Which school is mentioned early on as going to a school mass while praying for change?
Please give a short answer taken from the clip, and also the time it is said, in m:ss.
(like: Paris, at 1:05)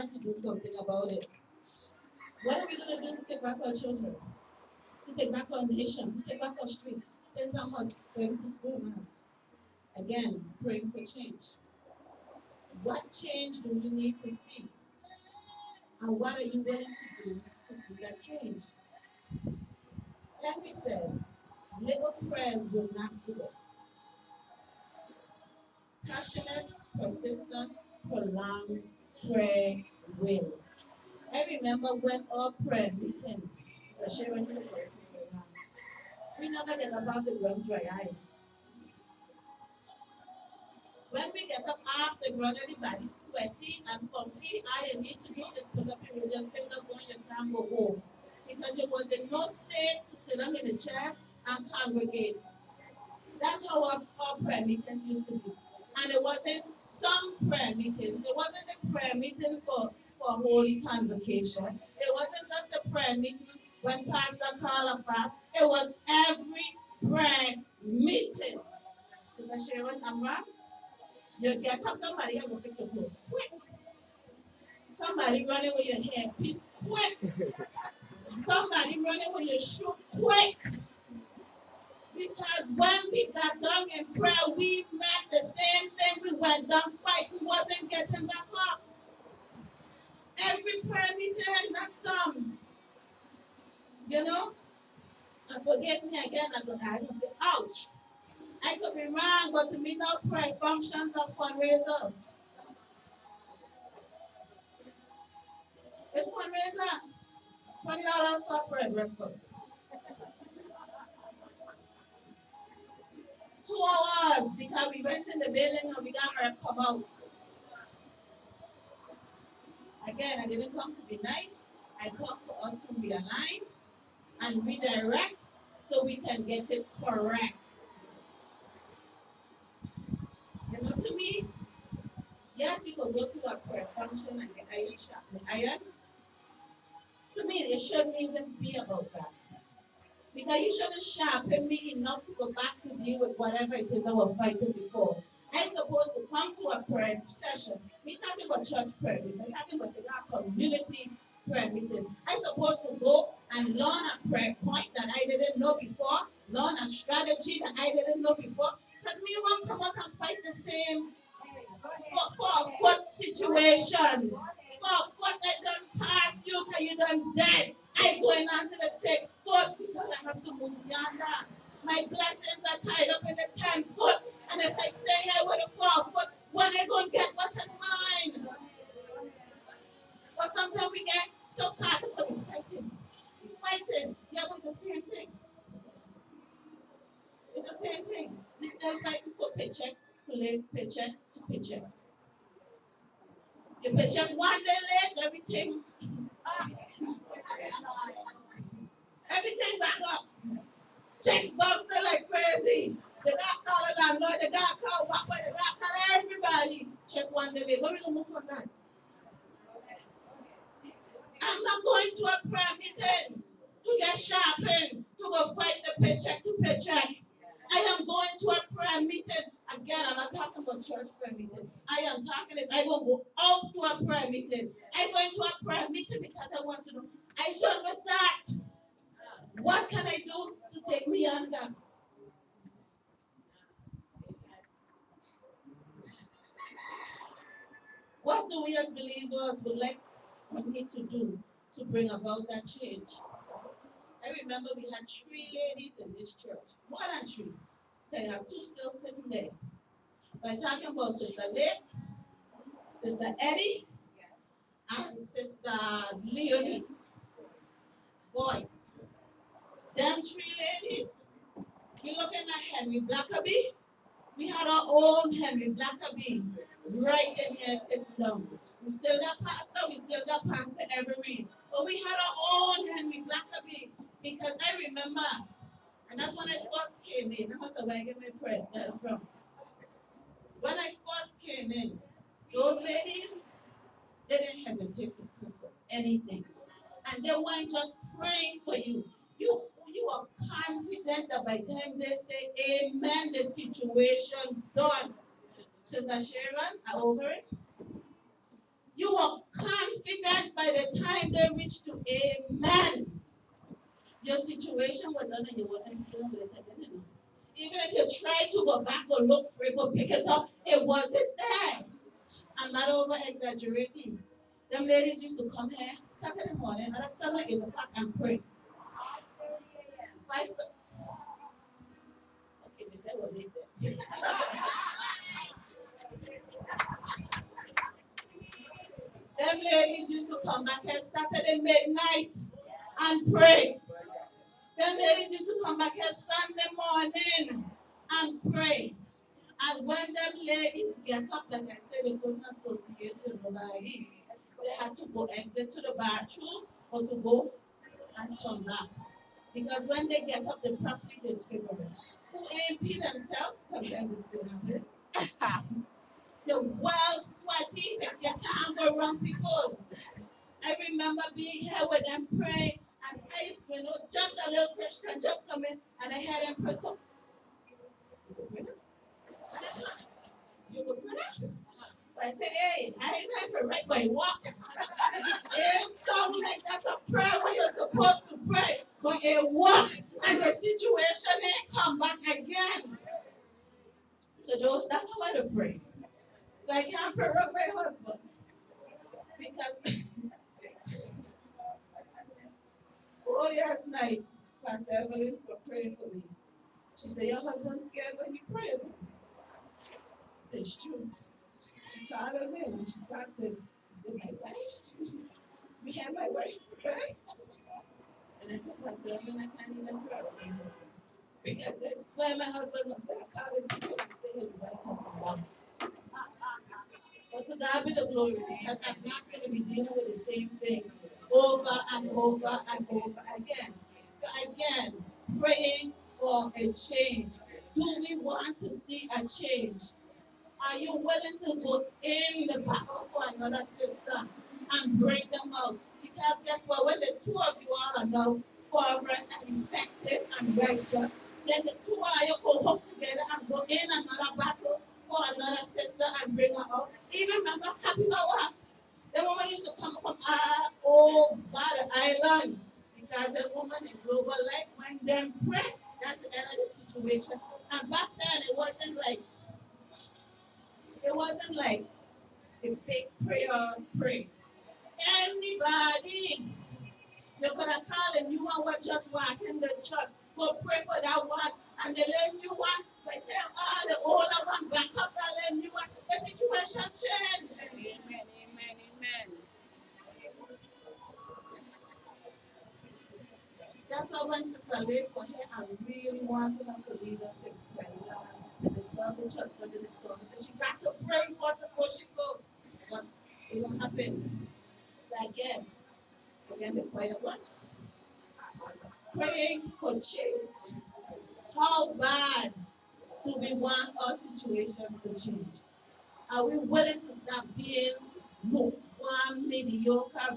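St. Thomas, at 0:07.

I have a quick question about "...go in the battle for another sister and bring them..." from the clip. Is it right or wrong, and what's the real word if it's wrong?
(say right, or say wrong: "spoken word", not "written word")
right.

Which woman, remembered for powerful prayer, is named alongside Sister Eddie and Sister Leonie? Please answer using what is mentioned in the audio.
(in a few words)
Sister Lake.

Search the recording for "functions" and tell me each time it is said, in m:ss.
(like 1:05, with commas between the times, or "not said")
1:40, 2:13.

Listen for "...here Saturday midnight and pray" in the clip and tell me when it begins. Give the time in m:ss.
5:30.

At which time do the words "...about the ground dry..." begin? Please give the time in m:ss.
0:36.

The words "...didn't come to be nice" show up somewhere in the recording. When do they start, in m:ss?
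2:00.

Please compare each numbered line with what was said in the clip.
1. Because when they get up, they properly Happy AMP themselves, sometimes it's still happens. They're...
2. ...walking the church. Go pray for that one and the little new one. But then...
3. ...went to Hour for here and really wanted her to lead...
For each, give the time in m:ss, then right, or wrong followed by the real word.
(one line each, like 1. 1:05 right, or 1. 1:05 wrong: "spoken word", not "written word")
1. 5:49 wrong: "Who", not "Happy"
2. 7:49 right
3. 8:04 wrong: "Stanley", not "Hour".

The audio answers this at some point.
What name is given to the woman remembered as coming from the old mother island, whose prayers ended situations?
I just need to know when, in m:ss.
7:27.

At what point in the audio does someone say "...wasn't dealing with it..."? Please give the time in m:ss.
5:05.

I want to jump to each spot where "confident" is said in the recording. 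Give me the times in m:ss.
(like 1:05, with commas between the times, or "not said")
4:50, 4:59.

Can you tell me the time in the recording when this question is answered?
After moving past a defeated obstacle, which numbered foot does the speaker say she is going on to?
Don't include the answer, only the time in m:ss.
2:48.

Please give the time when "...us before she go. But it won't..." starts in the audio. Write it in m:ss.
8:11.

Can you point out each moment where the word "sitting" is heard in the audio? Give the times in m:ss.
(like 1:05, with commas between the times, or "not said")
4:08, 4:27.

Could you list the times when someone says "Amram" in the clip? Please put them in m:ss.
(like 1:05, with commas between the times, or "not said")
1:10.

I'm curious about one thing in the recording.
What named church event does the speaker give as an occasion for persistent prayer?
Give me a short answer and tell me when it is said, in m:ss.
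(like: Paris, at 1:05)
Holy Convocation, at 1:00.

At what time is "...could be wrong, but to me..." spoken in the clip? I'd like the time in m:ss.
1:38.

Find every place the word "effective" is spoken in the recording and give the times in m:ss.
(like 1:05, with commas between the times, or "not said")
7:19.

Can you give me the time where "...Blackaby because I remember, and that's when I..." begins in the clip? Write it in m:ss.
4:33.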